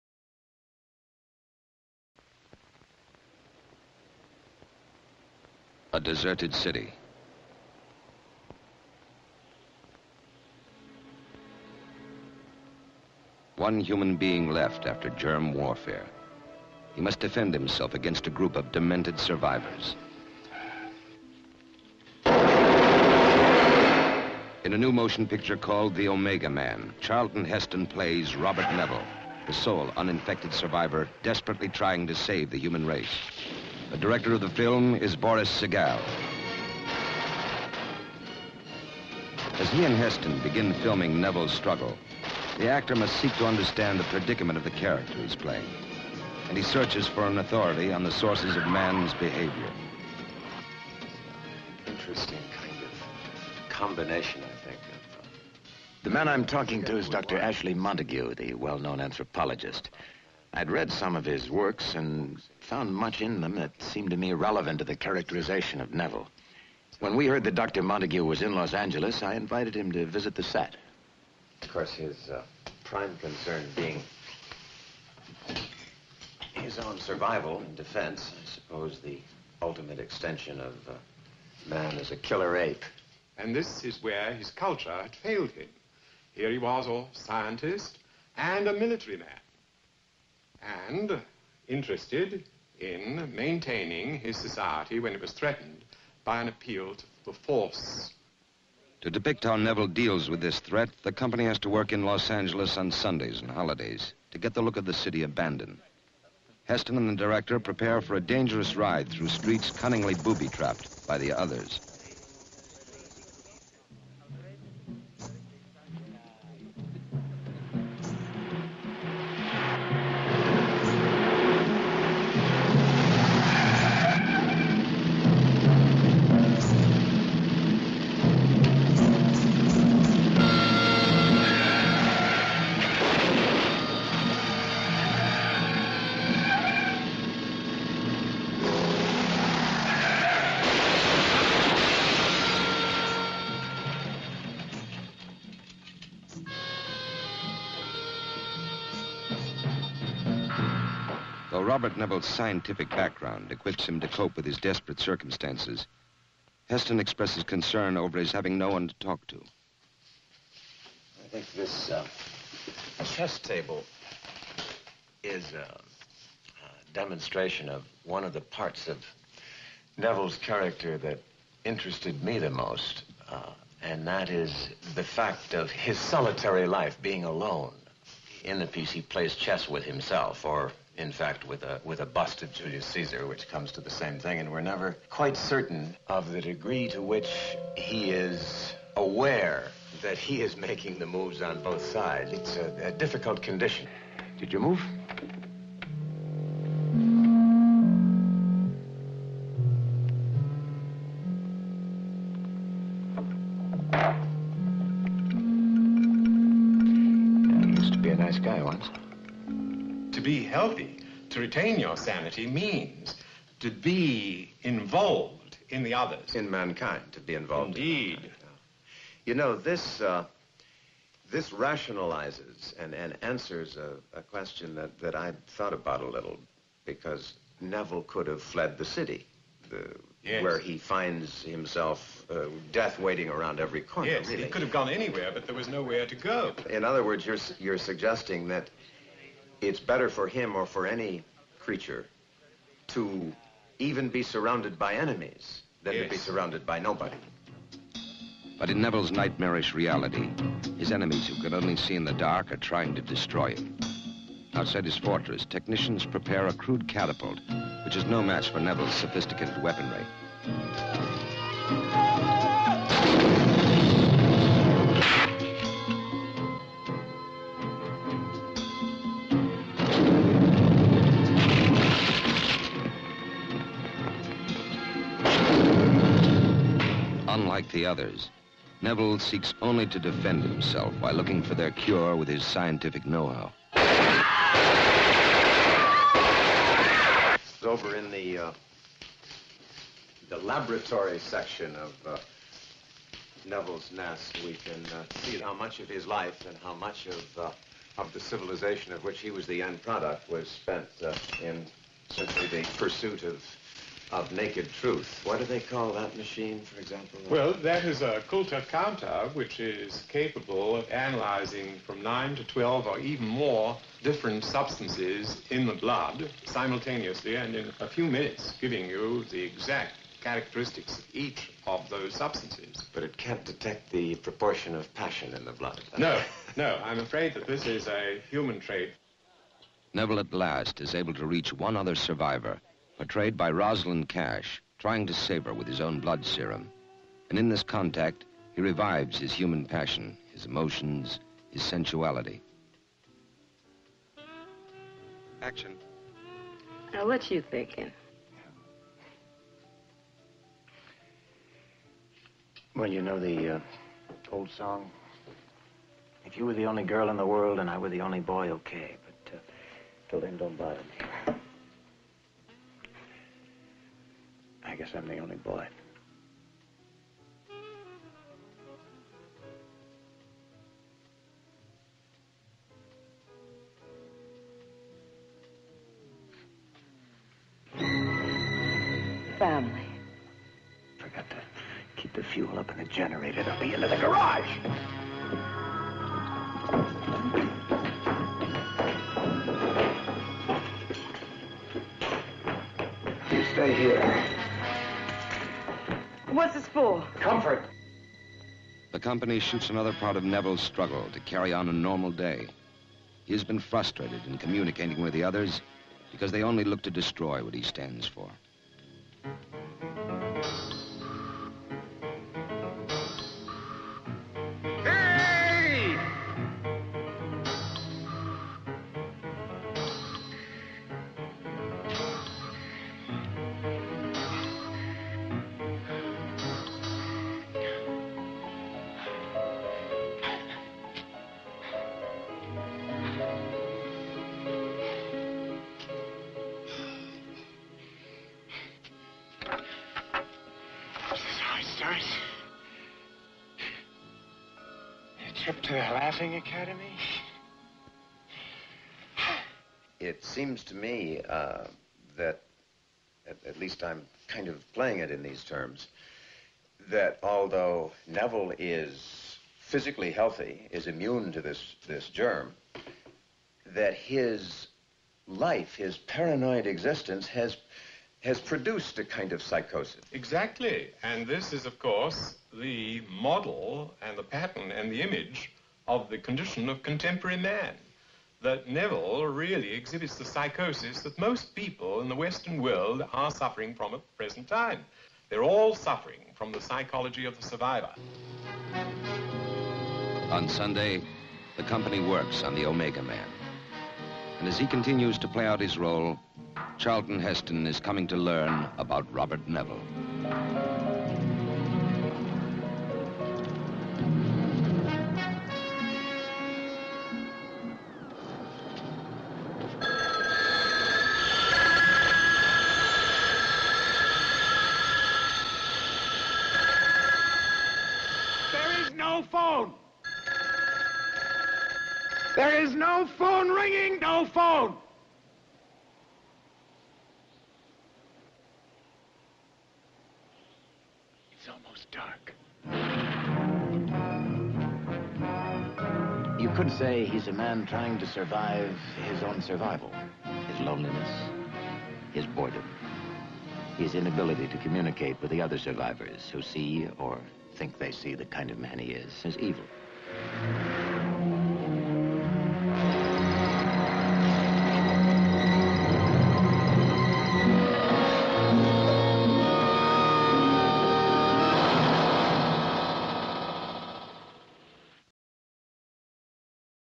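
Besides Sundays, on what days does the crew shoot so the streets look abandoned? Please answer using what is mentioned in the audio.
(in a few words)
holidays.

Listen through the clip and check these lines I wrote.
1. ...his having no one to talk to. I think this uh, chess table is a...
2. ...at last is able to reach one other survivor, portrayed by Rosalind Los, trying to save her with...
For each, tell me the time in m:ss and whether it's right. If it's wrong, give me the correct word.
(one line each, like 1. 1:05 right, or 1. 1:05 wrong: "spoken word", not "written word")
1. 2:38 right
2. 5:30 wrong: "Cash", not "Los".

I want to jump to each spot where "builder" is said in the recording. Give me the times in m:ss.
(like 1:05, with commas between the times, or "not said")
not said.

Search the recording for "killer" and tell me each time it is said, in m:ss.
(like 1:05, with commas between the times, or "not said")
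1:22.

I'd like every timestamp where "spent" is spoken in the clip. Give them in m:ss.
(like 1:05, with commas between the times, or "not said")
5:00.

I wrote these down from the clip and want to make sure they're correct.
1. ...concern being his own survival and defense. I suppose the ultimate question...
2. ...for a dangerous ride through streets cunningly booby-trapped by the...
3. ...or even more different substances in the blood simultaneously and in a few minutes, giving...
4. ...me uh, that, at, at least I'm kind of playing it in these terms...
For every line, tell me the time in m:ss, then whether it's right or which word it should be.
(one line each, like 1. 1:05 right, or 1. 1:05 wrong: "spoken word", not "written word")
1. 1:13 wrong: "extension", not "question"
2. 1:48 right
3. 5:12 right
4. 7:30 right.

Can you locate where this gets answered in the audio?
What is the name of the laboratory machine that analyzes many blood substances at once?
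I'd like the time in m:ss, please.
5:08.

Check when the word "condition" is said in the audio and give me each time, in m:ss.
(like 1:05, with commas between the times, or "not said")
3:13, 7:56.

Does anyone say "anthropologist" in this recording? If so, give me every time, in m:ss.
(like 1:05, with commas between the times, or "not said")
0:59.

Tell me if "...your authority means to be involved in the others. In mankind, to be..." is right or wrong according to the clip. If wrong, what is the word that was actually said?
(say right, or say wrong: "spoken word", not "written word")
wrong: "sanity", not "authority".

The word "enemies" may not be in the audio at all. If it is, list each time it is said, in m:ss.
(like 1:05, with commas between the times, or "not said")
4:04, 4:10.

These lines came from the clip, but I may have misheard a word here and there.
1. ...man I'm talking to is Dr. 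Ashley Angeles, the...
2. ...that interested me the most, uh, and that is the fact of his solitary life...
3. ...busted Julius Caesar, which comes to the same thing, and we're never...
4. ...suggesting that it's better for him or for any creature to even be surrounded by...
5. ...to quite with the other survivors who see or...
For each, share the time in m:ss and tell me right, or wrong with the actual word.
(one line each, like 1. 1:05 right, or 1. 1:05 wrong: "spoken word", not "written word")
1. 0:56 wrong: "Montagu", not "Angeles"
2. 2:50 right
3. 3:02 right
4. 3:57 right
5. 9:04 wrong: "communicate", not "quite".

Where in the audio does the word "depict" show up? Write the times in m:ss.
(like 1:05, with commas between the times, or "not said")
1:39.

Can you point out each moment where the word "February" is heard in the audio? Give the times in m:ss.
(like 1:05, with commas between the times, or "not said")
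not said.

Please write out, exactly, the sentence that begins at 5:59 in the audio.
But uh, till then, don't bother me.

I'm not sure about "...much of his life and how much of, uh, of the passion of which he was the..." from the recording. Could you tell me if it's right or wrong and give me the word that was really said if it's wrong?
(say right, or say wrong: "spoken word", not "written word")
wrong: "civilization", not "passion".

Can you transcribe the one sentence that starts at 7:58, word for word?
That Neville really exhibits the psychosis that most people in the Western world are suffering from at the present time.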